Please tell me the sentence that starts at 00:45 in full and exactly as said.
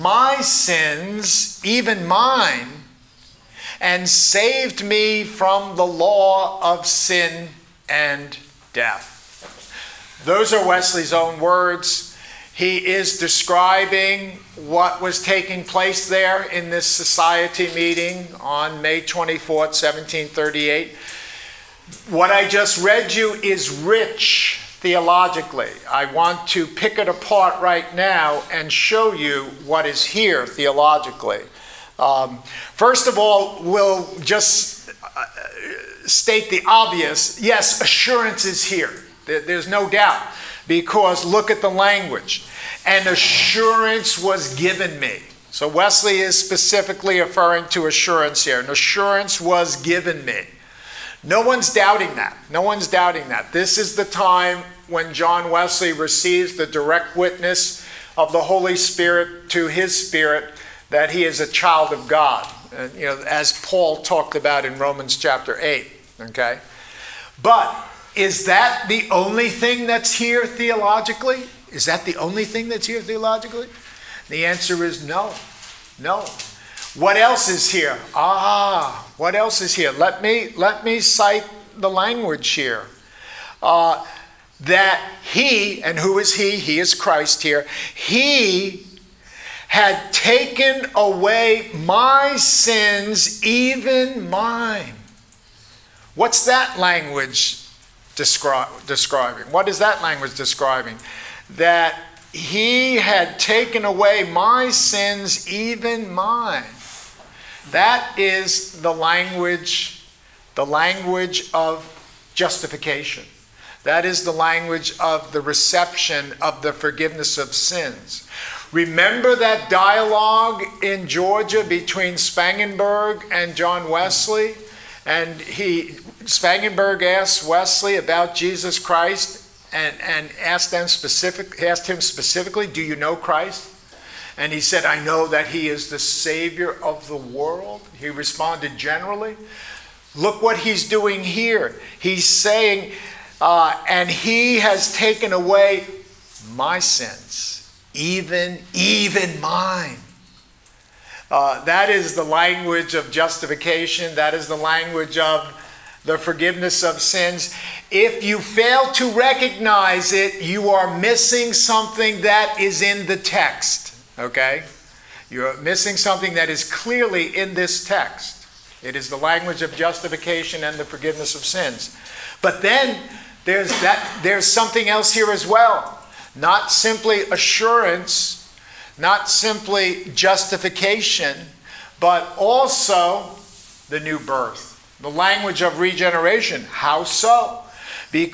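So Wesley is specifically referring to assurance here.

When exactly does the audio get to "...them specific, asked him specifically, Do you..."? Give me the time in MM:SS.
02:10.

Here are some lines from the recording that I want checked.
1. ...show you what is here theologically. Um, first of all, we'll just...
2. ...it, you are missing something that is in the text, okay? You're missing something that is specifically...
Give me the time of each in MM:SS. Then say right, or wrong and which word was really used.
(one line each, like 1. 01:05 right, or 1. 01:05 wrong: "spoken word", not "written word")
1. 00:28 right
2. 02:40 wrong: "clearly", not "specifically".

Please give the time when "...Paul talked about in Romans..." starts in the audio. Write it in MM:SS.
01:03.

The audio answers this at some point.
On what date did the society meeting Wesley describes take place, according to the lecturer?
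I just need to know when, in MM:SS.
00:18.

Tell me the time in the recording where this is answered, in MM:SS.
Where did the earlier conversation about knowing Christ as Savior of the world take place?
02:01.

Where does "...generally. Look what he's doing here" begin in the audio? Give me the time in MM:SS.
02:18.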